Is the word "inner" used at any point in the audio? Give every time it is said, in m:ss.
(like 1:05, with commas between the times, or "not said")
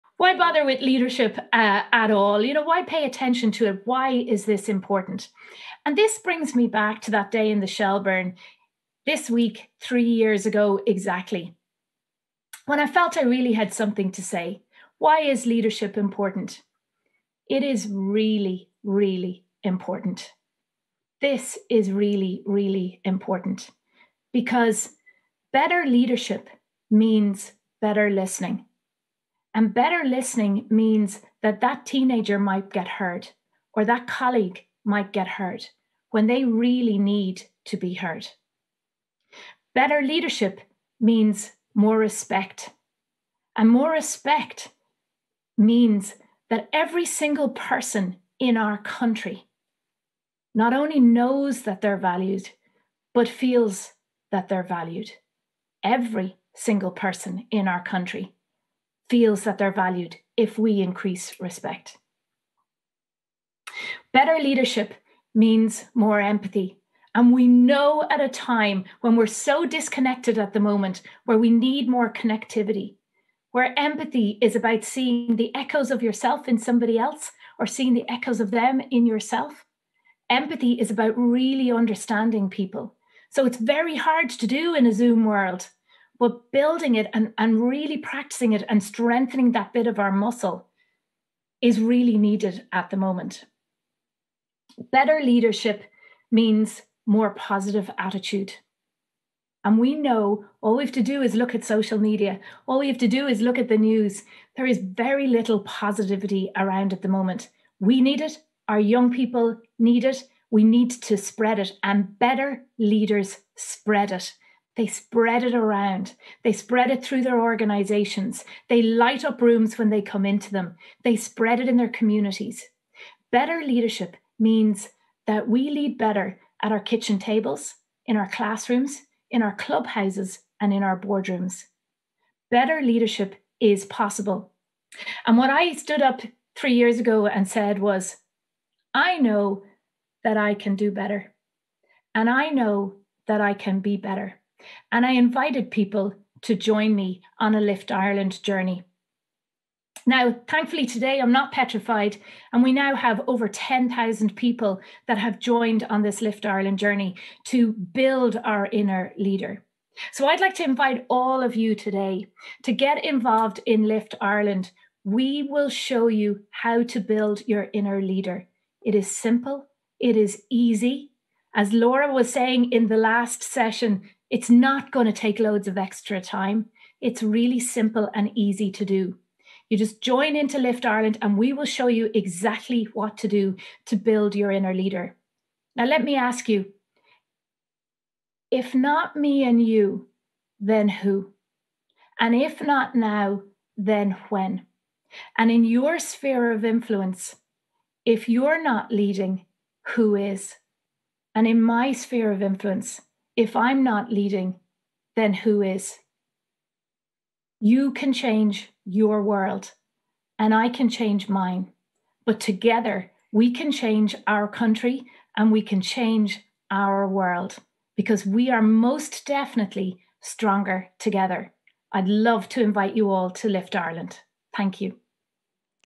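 2:38, 2:47, 3:04.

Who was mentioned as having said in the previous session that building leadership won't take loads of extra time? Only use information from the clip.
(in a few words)
Laura.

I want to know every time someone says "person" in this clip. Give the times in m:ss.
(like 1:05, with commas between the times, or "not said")
0:47, 0:56.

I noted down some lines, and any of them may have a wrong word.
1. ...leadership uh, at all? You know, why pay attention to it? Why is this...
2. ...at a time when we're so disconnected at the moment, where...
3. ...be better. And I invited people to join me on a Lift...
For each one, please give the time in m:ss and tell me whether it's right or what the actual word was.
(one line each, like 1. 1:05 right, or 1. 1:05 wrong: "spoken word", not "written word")
1. 0:00 right
2. 1:08 right
3. 2:23 right.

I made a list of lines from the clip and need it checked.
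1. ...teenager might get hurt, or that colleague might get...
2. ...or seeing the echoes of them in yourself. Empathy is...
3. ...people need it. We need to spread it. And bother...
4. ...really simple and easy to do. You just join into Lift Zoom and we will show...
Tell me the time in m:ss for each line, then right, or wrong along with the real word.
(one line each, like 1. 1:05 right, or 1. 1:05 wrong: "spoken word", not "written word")
1. 0:31 right
2. 1:17 right
3. 1:49 wrong: "better", not "bother"
4. 2:57 wrong: "Ireland", not "Zoom".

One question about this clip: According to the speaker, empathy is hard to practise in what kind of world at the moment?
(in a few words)
A Zoom world.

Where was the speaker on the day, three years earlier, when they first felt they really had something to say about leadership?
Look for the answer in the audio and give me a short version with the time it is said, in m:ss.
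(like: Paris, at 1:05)
The Shelburne, at 0:07.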